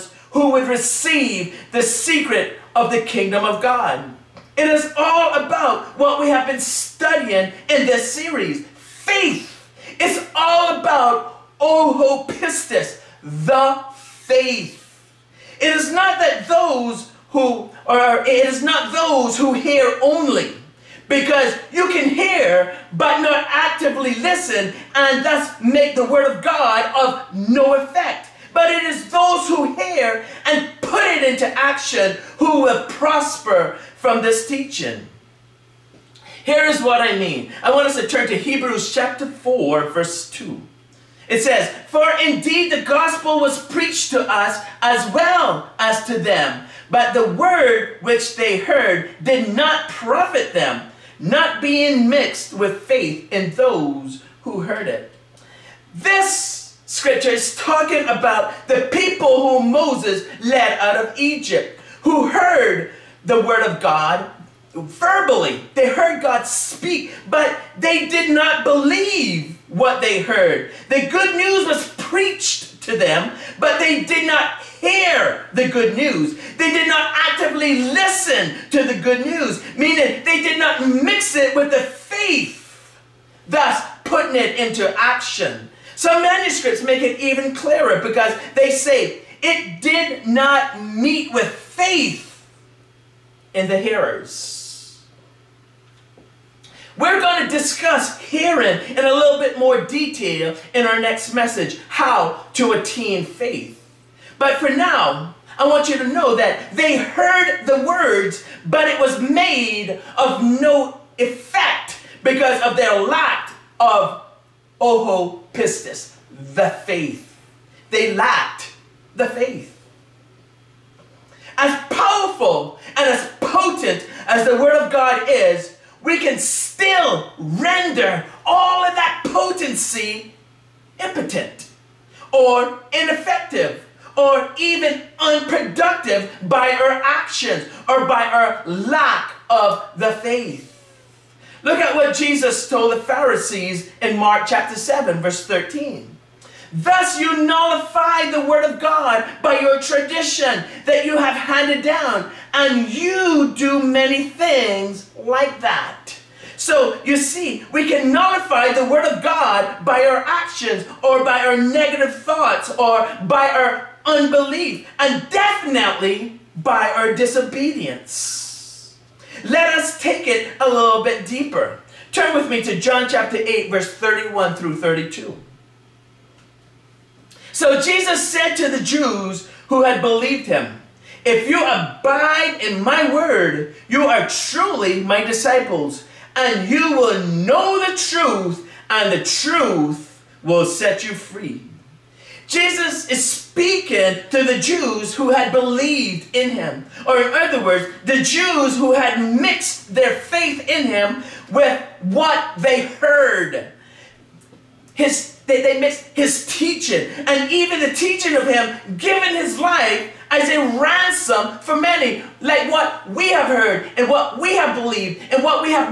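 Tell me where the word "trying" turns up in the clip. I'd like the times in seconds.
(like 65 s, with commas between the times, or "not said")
not said.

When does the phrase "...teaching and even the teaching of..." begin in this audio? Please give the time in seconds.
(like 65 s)
206 s.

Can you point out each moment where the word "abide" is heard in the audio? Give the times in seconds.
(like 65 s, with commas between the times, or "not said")
181 s.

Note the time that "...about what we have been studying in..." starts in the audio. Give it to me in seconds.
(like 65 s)
5 s.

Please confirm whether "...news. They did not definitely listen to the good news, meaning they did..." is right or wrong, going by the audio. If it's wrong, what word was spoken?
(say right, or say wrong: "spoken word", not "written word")
wrong: "actively", not "definitely".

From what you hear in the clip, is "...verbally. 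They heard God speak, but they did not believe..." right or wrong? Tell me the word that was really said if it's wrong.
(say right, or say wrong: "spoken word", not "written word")
right.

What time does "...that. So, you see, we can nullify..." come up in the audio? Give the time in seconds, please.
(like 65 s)
155 s.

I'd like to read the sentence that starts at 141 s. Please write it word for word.
Look at what Jesus told the Pharisees in Mark chapter 7, verse 13.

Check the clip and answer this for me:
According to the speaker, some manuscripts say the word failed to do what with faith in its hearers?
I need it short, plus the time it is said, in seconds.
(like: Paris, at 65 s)
meet, at 90 s.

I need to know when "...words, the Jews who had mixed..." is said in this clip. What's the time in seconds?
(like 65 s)
197 s.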